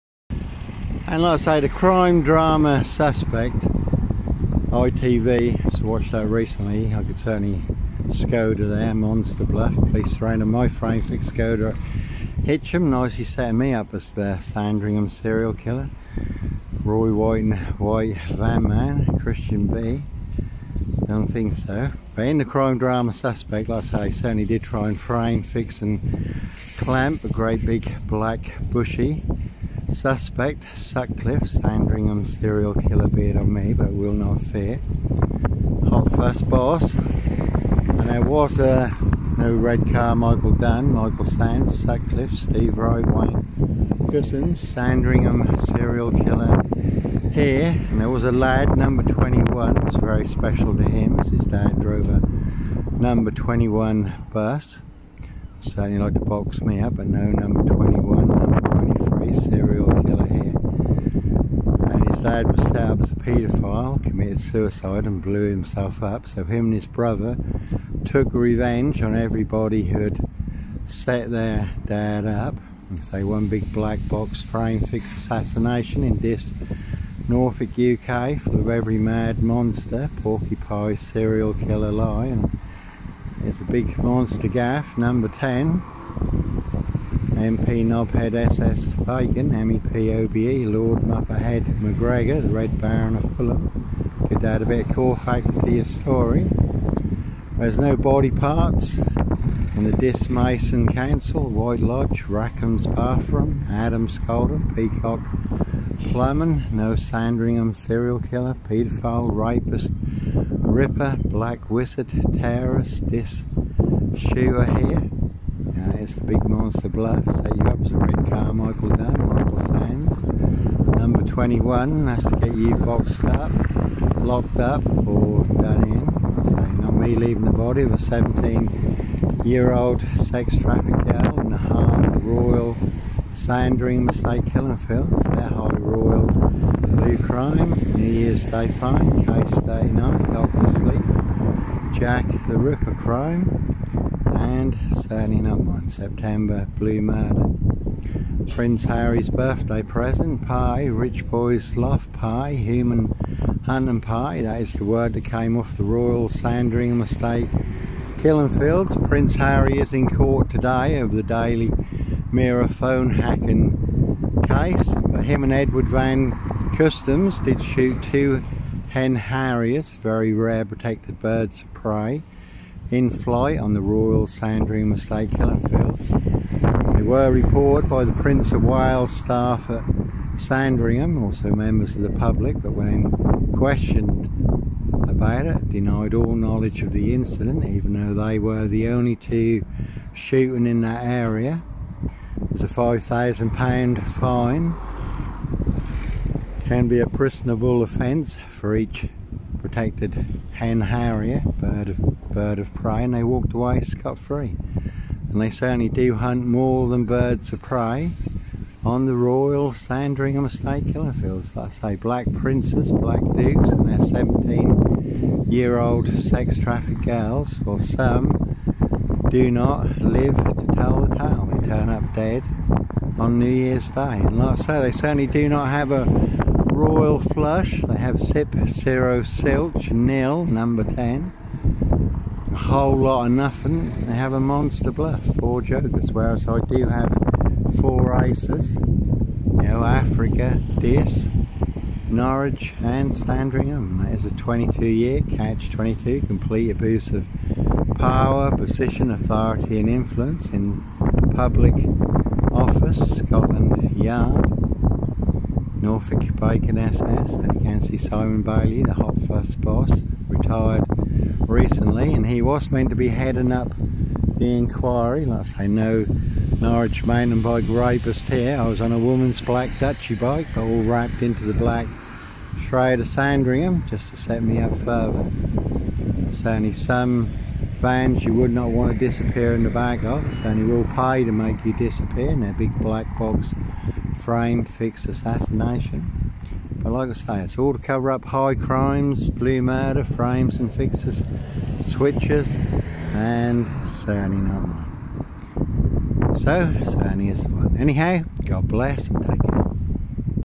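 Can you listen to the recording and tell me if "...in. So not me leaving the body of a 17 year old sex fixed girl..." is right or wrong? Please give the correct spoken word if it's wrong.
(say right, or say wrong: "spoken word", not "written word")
wrong: "trafficked", not "fixed".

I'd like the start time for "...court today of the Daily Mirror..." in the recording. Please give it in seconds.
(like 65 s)
160 s.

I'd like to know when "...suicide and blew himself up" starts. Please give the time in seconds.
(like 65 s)
64 s.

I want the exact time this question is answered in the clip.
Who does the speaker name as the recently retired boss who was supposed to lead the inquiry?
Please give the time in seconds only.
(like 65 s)
257 s.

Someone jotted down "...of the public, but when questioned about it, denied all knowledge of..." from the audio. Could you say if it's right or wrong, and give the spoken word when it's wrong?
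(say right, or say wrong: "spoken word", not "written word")
right.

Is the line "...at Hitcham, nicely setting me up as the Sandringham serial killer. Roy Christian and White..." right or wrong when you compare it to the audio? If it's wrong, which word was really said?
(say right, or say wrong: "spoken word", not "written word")
wrong: "White", not "Christian".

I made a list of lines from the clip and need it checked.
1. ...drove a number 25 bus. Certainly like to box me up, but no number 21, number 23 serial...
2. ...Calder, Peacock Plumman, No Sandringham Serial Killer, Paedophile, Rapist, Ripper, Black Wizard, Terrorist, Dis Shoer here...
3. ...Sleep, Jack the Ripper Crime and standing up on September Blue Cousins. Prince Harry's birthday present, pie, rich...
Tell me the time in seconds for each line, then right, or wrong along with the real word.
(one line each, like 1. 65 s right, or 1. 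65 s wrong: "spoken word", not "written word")
1. 51 s wrong: "21", not "25"
2. 104 s right
3. 140 s wrong: "Murder", not "Cousins".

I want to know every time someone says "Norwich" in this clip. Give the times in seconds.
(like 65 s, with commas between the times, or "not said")
242 s, 266 s.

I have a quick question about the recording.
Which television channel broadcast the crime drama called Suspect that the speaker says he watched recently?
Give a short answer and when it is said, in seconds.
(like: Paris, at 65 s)
ITV, at 4 s.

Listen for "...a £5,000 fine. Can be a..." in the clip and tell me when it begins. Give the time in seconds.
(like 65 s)
192 s.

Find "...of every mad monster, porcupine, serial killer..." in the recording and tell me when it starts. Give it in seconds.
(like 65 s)
78 s.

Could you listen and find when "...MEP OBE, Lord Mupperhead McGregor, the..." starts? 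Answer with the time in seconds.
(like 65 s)
89 s.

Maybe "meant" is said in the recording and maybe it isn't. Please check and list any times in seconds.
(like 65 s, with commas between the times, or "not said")
262 s.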